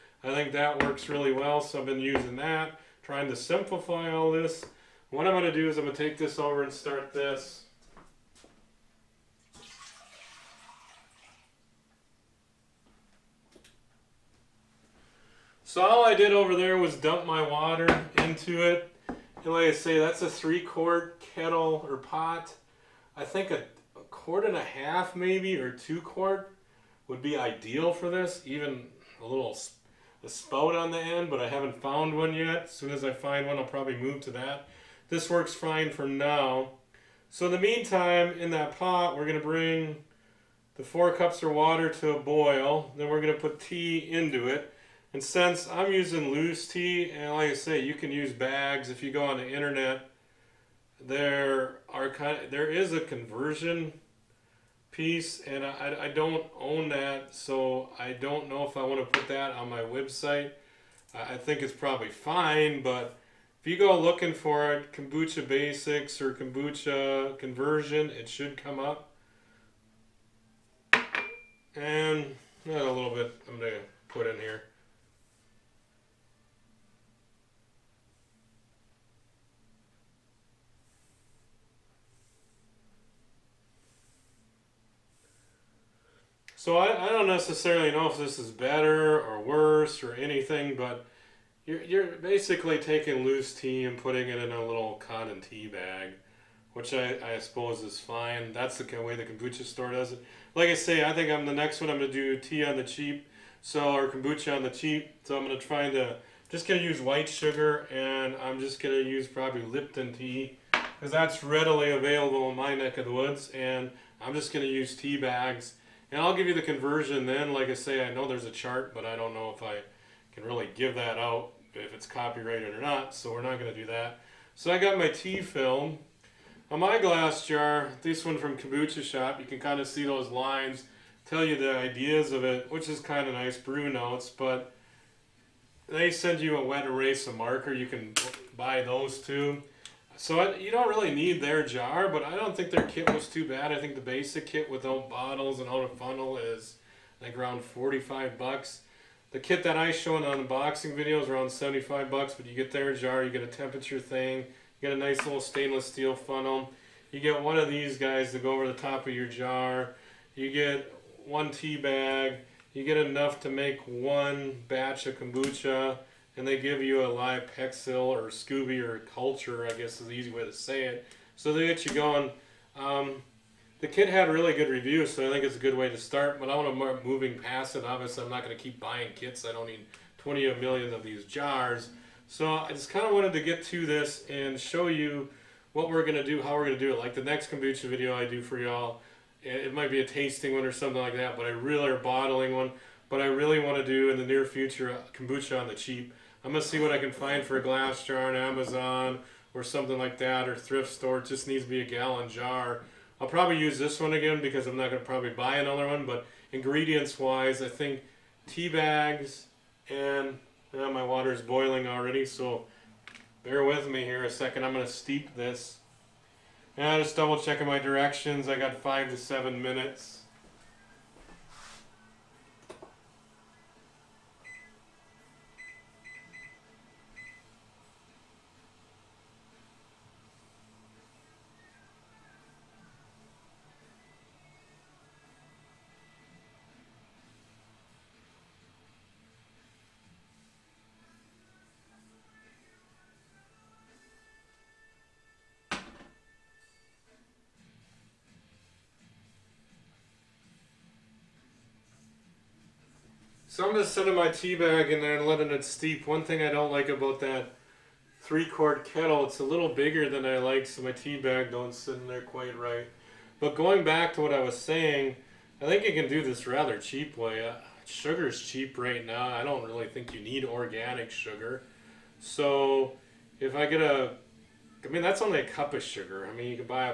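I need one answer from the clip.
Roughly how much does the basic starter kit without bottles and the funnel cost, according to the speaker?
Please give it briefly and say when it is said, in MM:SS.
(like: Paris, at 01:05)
$45, at 02:27.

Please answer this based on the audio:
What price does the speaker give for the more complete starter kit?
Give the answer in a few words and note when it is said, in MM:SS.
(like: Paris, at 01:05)
$75, at 02:31.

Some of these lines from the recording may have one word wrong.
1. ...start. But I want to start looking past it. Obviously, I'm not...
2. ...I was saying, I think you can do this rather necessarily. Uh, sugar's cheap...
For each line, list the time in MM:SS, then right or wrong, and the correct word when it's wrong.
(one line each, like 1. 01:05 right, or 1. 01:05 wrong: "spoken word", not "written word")
1. 02:55 wrong: "moving", not "looking"
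2. 04:24 wrong: "cheaply", not "necessarily".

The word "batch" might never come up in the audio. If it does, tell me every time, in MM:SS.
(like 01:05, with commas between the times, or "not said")
02:44.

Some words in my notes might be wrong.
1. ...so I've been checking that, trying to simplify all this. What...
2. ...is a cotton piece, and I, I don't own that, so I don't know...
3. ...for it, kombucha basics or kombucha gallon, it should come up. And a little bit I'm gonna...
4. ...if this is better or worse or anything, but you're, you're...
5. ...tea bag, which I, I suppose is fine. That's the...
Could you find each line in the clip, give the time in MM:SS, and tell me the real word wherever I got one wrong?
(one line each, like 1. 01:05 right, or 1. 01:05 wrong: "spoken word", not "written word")
1. 00:01 wrong: "using", not "checking"
2. 00:52 wrong: "conversion", not "cotton"
3. 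01:04 wrong: "conversion", not "gallon"
4. 01:28 right
5. 01:35 right.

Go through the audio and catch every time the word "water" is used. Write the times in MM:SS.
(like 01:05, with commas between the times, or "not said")
00:17, 00:41, 03:31.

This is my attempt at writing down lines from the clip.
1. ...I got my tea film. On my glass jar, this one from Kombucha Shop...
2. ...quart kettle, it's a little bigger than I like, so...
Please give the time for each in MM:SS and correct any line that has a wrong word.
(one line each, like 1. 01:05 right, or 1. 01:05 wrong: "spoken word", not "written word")
1. 02:04 right
2. 04:18 right.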